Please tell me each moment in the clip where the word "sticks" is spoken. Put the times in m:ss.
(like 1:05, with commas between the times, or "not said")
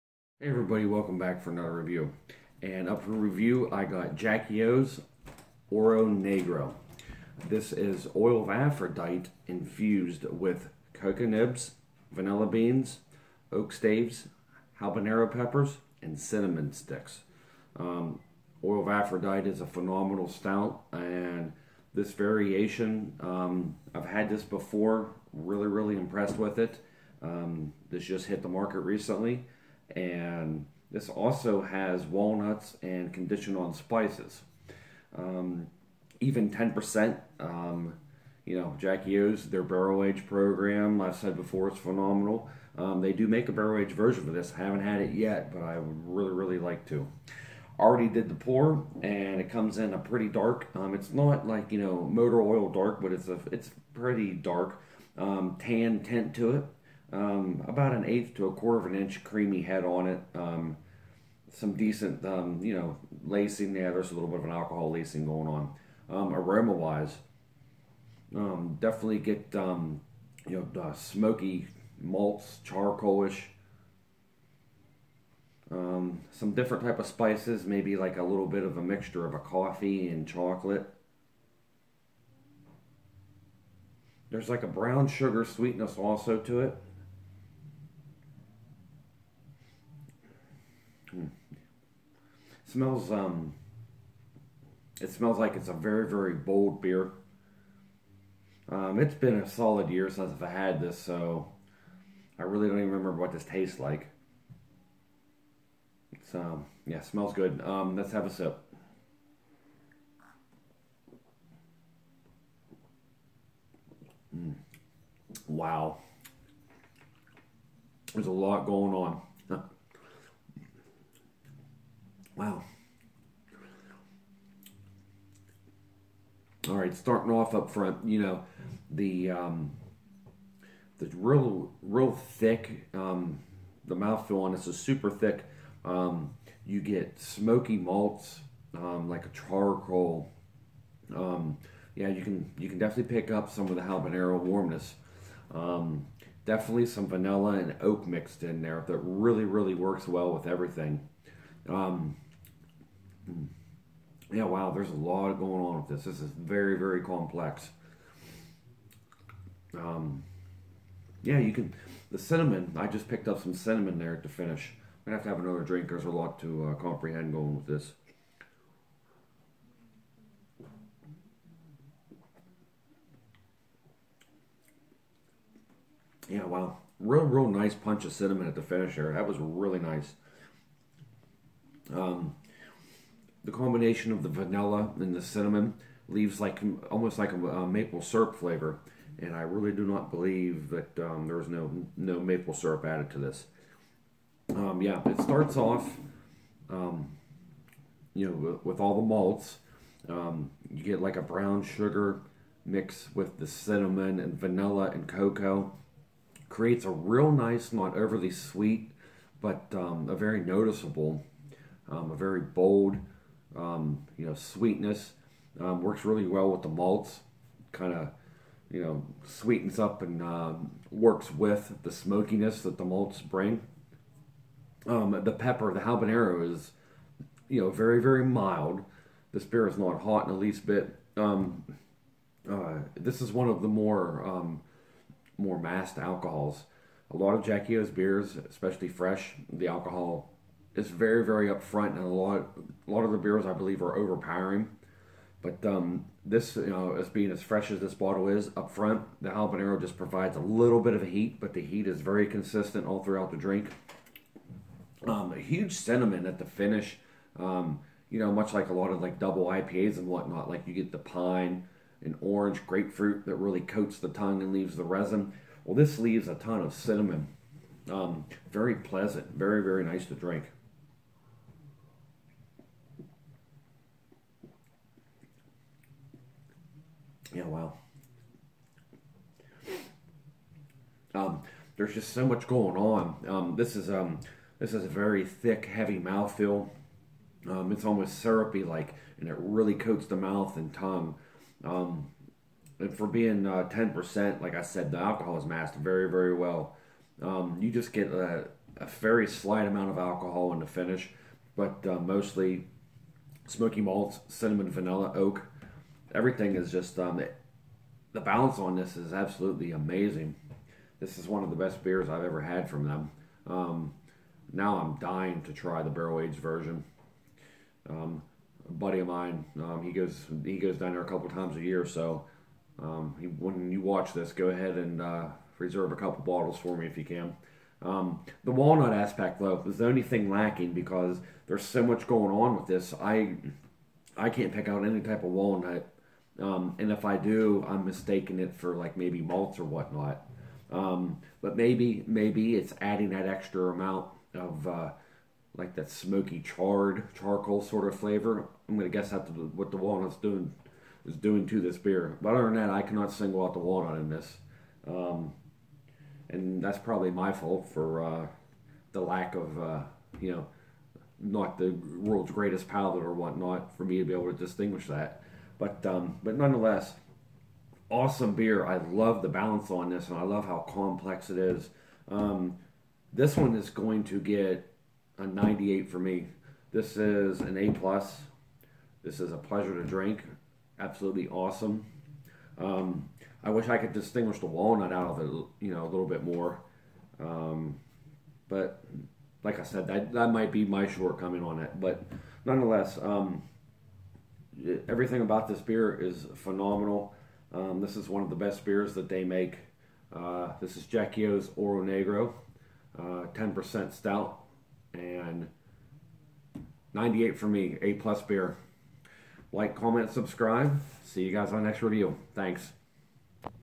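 0:16.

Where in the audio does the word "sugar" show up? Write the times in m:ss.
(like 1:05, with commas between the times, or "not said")
1:25, 3:21.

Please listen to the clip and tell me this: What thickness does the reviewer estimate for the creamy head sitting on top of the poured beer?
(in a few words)
an eighth to a quarter of an inch.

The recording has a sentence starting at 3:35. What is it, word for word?
Um, works really well with the malts.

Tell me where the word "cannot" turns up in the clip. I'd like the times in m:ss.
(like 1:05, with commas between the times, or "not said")
5:52.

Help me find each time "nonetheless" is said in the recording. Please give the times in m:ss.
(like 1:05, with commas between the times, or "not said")
6:06, 6:32.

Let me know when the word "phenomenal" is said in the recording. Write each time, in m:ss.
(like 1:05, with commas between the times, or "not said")
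0:19, 0:41, 6:36.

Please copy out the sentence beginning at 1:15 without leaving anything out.
Um, some different type of spices, maybe like a little bit of a mixture of a coffee and chocolate.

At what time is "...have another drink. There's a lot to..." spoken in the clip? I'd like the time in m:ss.
2:45.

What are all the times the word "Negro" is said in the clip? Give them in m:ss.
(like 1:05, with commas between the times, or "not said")
0:06, 6:41.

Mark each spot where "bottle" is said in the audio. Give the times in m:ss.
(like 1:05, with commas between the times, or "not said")
4:07, 5:26.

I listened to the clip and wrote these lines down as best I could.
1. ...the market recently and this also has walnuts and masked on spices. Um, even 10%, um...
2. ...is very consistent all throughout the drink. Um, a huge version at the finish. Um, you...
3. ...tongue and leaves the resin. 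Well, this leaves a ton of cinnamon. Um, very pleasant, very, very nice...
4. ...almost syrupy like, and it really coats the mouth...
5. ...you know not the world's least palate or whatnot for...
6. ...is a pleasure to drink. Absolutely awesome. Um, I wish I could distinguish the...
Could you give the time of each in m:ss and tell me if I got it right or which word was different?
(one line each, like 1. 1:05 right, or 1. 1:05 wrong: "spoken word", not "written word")
1. 0:28 wrong: "conditioned", not "masked"
2. 4:11 wrong: "cinnamon", not "version"
3. 4:24 right
4. 4:47 right
5. 6:00 wrong: "greatest", not "least"
6. 6:19 right.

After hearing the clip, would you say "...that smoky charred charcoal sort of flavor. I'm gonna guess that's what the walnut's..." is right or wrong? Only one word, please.
right.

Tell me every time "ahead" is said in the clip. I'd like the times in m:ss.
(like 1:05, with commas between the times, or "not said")
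5:24.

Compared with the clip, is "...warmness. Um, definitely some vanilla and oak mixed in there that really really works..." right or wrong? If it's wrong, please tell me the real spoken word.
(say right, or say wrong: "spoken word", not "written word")
right.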